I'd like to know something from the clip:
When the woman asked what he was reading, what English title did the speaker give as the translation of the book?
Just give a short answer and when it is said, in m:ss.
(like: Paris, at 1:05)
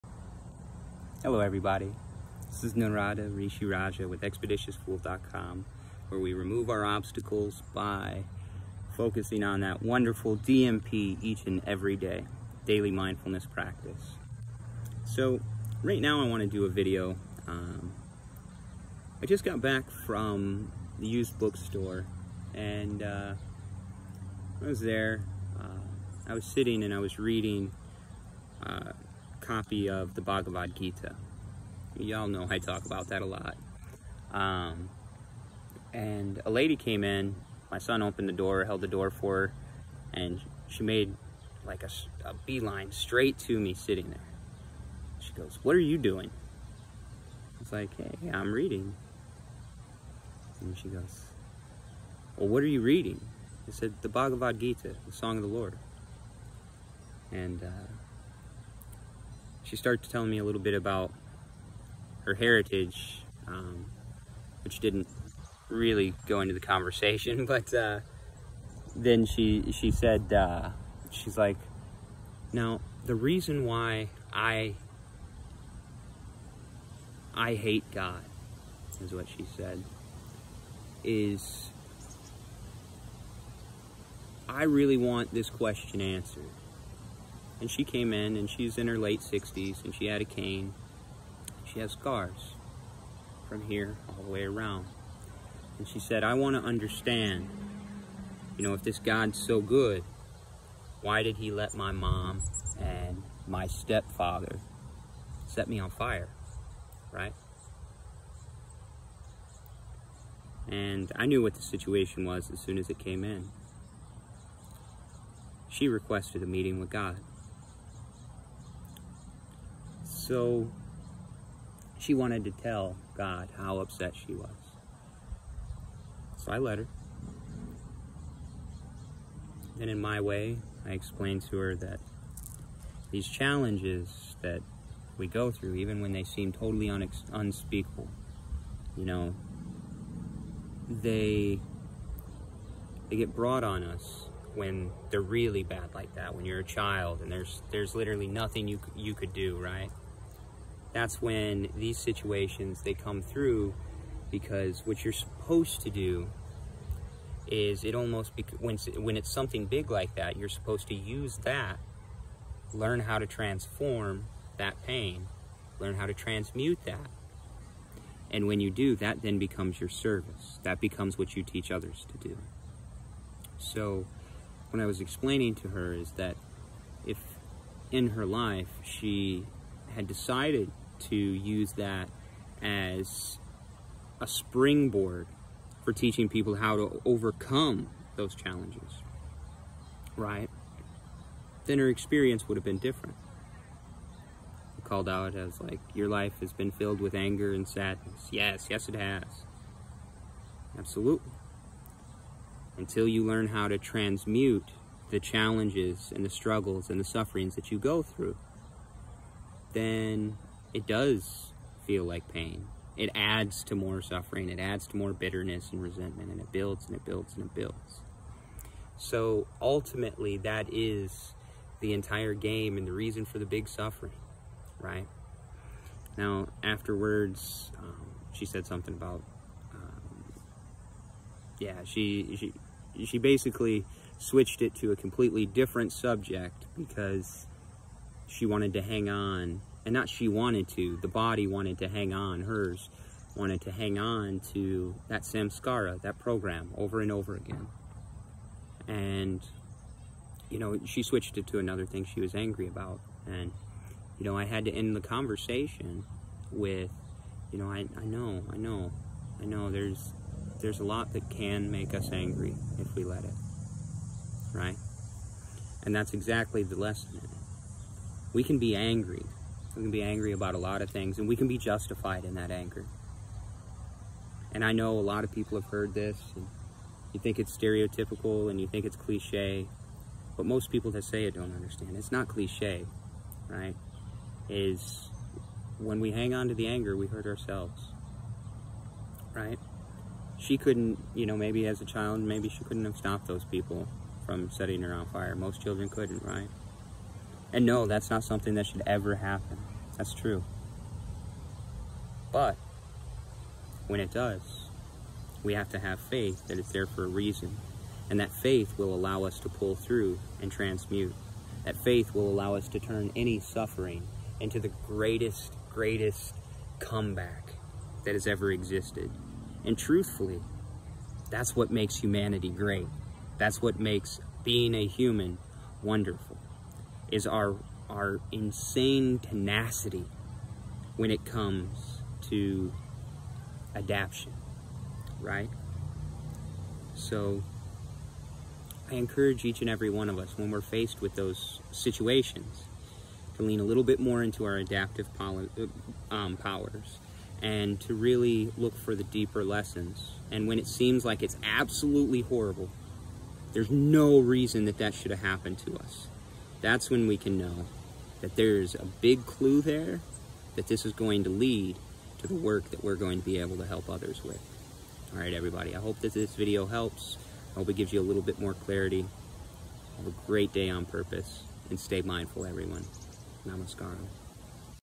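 The Song of the Lord, at 0:55.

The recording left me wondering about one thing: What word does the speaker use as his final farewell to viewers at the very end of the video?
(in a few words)
Namaskaram.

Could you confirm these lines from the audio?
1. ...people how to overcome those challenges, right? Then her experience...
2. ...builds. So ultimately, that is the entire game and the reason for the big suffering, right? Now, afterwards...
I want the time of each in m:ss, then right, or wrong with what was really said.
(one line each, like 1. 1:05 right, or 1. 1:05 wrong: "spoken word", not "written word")
1. 3:06 right
2. 3:37 right.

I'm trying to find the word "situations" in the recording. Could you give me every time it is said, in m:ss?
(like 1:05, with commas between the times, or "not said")
1:51, 2:31, 5:41.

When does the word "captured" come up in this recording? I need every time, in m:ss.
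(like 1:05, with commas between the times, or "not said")
not said.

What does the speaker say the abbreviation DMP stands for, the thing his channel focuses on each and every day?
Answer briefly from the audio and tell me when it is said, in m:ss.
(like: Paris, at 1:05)
daily mindfulness practice, at 0:12.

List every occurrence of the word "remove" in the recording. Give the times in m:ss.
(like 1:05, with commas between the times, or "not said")
0:06.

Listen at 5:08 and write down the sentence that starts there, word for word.
And that faith will allow us to pull through and transmute.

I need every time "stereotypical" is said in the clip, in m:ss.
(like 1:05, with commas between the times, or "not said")
4:37.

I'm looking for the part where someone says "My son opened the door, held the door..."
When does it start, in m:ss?
0:37.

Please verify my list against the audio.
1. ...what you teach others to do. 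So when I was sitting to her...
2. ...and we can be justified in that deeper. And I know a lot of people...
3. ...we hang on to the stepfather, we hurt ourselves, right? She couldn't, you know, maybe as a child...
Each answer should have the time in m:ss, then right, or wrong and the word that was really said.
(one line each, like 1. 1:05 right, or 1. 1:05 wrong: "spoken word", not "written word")
1. 2:51 wrong: "explaining", not "sitting"
2. 4:31 wrong: "anger", not "deeper"
3. 4:46 wrong: "anger", not "stepfather".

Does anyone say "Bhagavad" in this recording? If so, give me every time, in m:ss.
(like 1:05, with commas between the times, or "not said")
0:30, 0:54.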